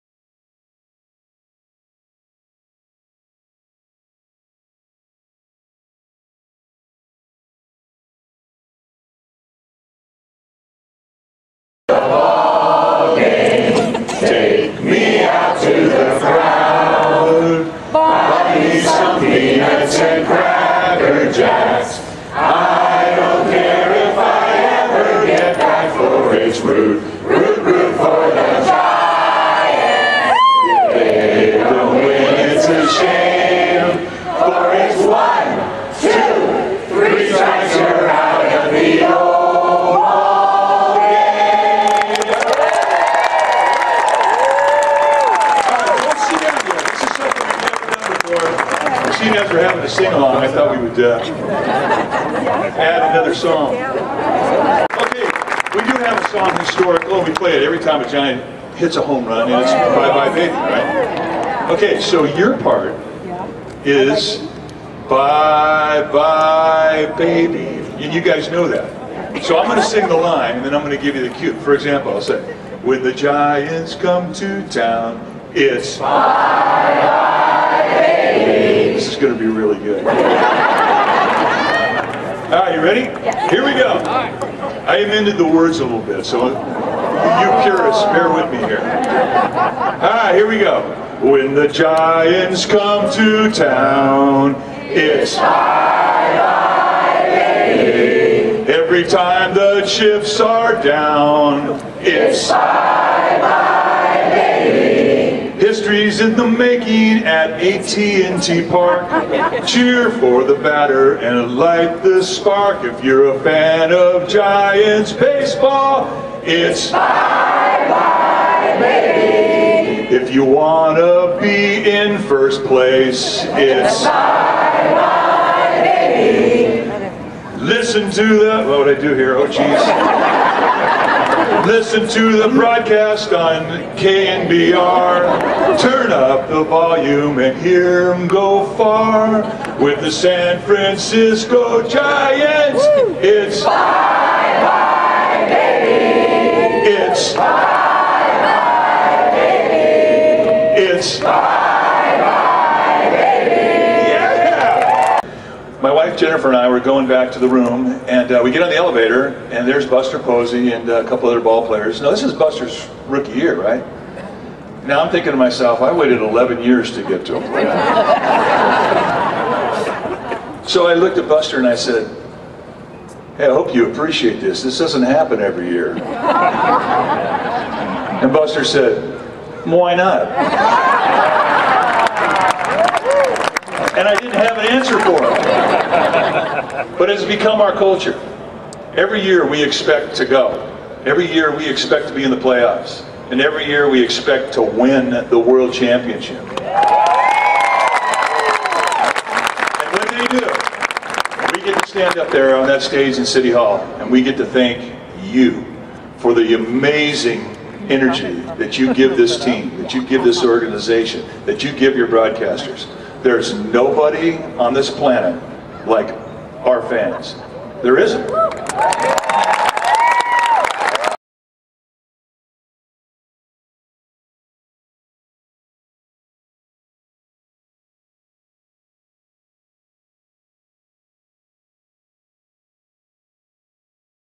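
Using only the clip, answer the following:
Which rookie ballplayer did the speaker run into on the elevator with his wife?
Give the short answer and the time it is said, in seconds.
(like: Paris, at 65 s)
Buster Posey, at 159 s.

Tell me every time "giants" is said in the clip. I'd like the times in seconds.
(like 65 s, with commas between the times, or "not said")
58 s, 73 s, 91 s, 114 s, 141 s.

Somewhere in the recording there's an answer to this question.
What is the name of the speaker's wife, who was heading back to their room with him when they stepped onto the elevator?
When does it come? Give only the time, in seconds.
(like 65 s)
156 s.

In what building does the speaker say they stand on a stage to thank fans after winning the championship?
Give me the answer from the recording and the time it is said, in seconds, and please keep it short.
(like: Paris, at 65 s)
City Hall, at 203 s.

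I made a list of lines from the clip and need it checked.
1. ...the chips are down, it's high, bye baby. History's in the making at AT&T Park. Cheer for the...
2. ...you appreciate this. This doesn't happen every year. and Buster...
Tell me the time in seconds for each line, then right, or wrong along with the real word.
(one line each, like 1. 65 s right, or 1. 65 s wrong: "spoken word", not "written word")
1. 99 s right
2. 173 s right.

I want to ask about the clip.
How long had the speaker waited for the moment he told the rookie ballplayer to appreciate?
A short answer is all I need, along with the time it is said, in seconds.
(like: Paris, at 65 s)
11 years, at 166 s.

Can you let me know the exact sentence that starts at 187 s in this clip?
But it has become our culture.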